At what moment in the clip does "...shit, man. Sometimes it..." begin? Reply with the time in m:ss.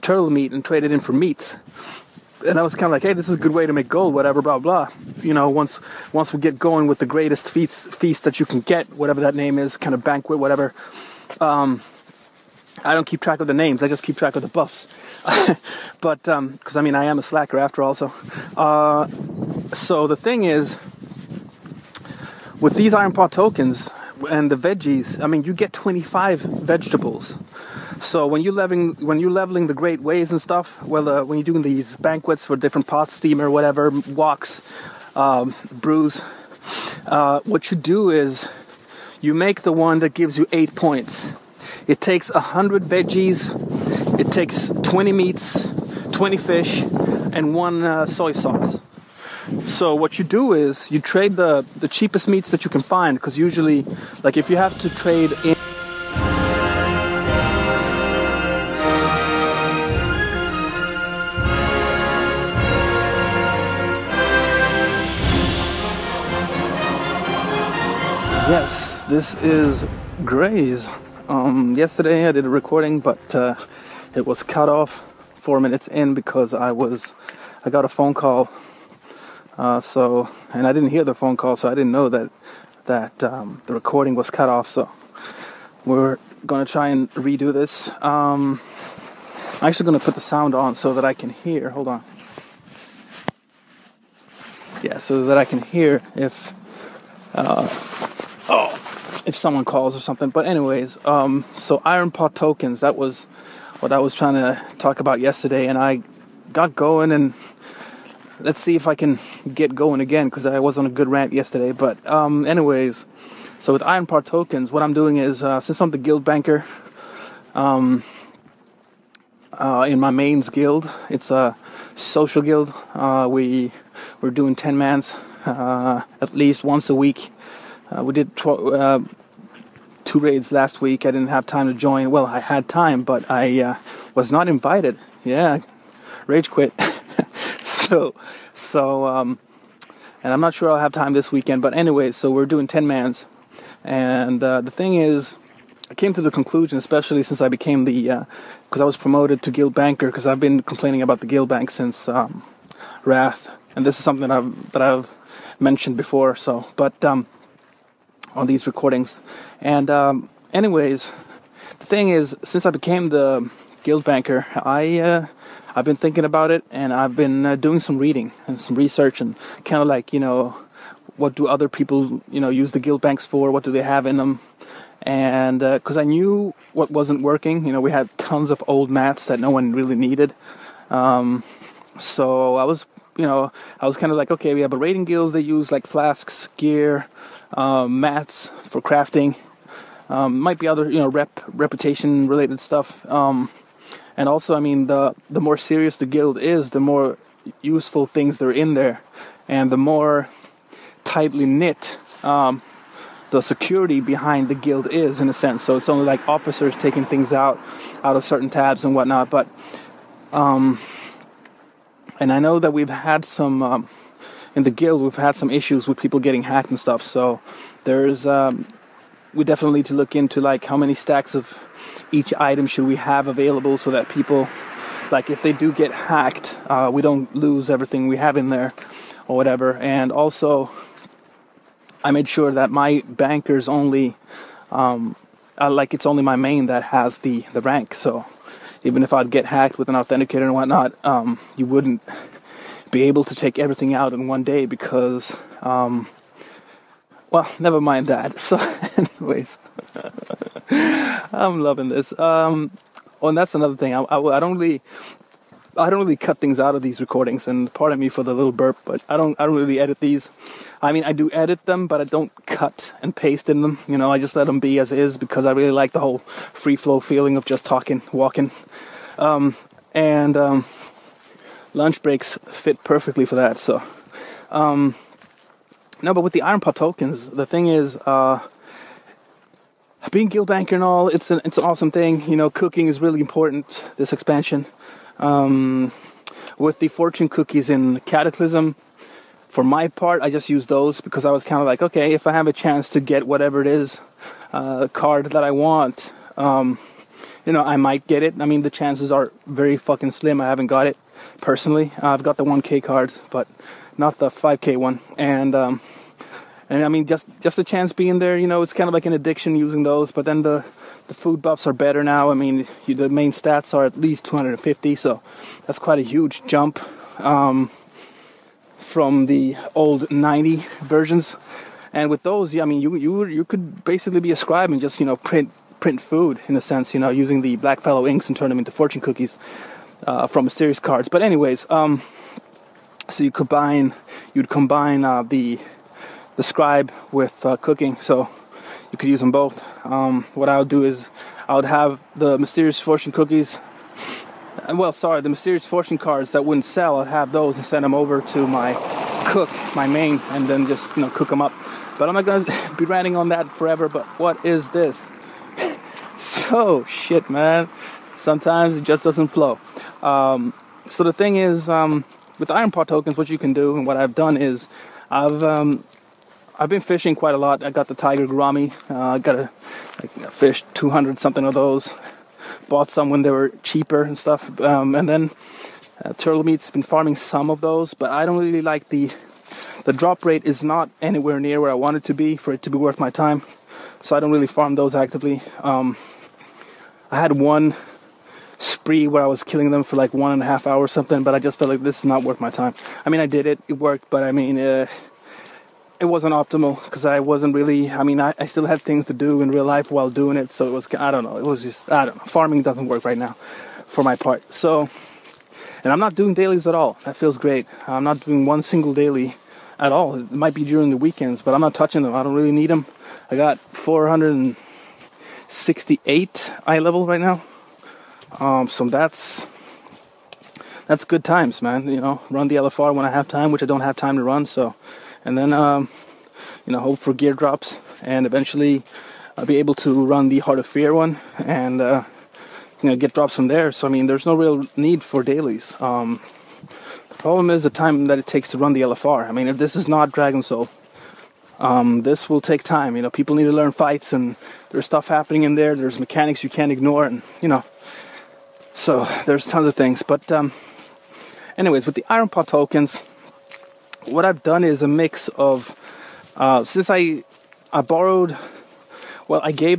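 5:56.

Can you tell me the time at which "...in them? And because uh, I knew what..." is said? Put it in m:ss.
2:54.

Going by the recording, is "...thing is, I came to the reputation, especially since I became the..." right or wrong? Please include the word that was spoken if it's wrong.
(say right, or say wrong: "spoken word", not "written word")
wrong: "conclusion", not "reputation".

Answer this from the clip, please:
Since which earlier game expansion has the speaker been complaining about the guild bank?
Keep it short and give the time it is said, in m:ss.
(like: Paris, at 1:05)
Wrath, at 2:33.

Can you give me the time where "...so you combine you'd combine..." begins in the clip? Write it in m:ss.
5:33.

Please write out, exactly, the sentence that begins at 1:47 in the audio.
And let's see if I can get going again because I was on a good rant yesterday.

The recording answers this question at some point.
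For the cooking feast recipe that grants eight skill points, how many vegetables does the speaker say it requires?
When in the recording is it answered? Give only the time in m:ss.
0:42.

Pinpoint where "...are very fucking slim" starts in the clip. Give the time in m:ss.
4:59.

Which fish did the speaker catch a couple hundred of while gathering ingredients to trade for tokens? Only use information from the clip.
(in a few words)
Tiger gourami.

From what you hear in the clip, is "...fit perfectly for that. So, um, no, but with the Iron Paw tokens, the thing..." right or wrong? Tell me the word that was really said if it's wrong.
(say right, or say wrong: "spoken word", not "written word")
right.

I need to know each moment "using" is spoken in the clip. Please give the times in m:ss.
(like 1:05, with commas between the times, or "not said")
5:09, 5:27.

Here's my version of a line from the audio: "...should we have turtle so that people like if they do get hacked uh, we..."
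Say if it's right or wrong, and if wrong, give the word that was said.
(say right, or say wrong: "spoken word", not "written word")
wrong: "available", not "turtle".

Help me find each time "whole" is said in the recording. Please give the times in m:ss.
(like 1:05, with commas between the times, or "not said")
4:25.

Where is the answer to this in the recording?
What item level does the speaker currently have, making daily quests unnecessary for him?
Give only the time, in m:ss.
6:53.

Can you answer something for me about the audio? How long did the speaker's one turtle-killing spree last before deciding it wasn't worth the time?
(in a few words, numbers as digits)
One and a half hours.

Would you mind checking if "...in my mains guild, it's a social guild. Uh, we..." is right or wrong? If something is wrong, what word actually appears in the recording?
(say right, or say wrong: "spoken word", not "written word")
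right.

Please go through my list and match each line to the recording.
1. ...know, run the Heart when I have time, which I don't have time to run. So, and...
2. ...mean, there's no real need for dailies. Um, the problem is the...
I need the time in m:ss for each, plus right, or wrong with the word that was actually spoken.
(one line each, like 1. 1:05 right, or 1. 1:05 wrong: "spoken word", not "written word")
1. 7:01 wrong: "LFR", not "Heart"
2. 7:13 right.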